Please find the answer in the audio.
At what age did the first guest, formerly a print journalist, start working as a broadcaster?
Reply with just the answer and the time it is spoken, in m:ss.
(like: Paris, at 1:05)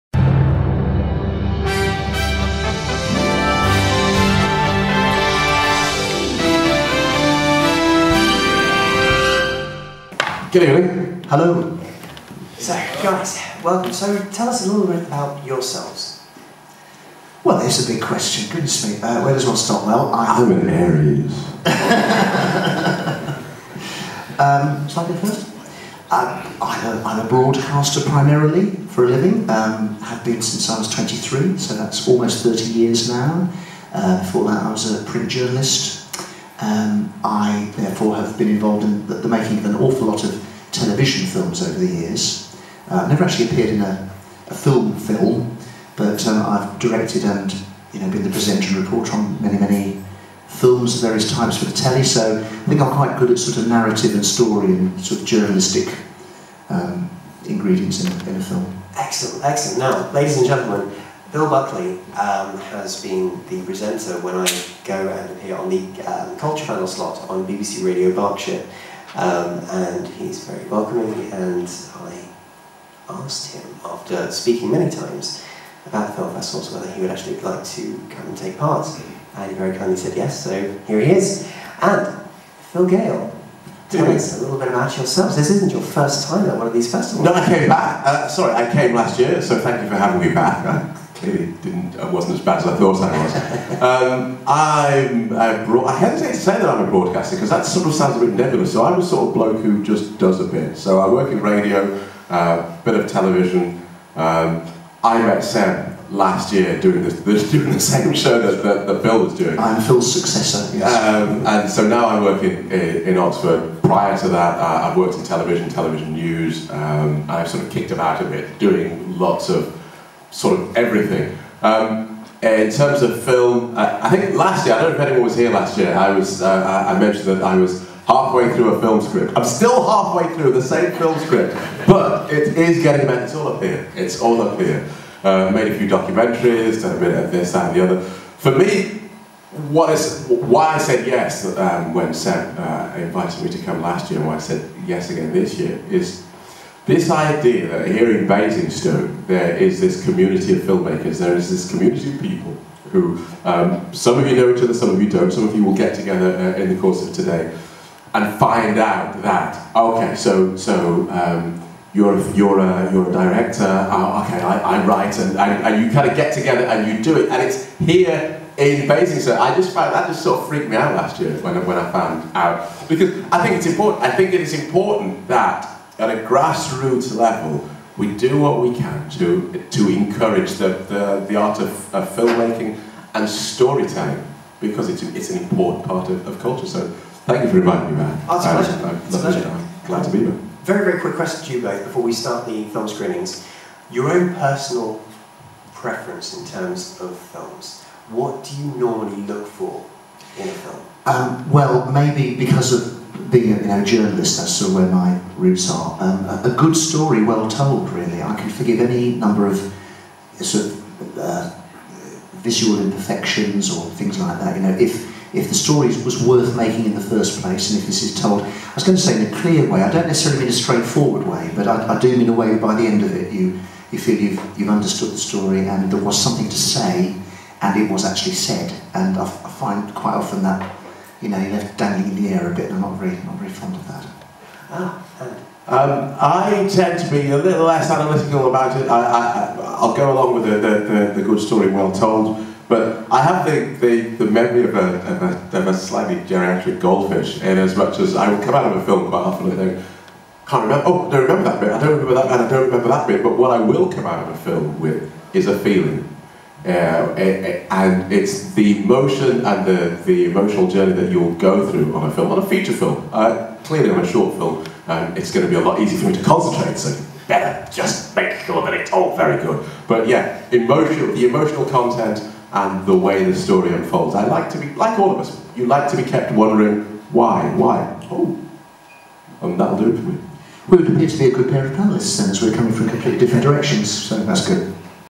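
23, at 0:30.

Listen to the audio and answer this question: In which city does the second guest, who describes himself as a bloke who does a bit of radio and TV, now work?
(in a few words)
Oxford.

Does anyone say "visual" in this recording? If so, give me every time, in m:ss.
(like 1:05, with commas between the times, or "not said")
3:32.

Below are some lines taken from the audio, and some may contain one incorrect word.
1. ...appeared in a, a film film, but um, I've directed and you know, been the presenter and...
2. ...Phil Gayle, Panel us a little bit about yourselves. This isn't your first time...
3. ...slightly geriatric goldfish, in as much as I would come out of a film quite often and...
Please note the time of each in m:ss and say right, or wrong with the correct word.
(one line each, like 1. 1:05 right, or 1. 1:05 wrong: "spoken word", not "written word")
1. 0:43 right
2. 1:22 wrong: "Tell", not "Panel"
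3. 4:05 right.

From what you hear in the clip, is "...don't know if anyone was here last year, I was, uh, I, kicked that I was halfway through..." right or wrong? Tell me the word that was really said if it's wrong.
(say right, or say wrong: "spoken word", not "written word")
wrong: "mentioned", not "kicked".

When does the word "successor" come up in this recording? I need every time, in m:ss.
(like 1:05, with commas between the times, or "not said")
1:50.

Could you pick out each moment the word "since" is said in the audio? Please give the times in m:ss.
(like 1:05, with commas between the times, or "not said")
0:30, 4:42.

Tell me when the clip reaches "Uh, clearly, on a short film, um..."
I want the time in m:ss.
4:23.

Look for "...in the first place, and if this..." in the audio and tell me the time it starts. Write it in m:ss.
3:36.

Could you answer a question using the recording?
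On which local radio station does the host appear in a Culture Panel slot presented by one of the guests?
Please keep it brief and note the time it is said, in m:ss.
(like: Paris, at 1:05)
BBC Radio Berkshire, at 1:07.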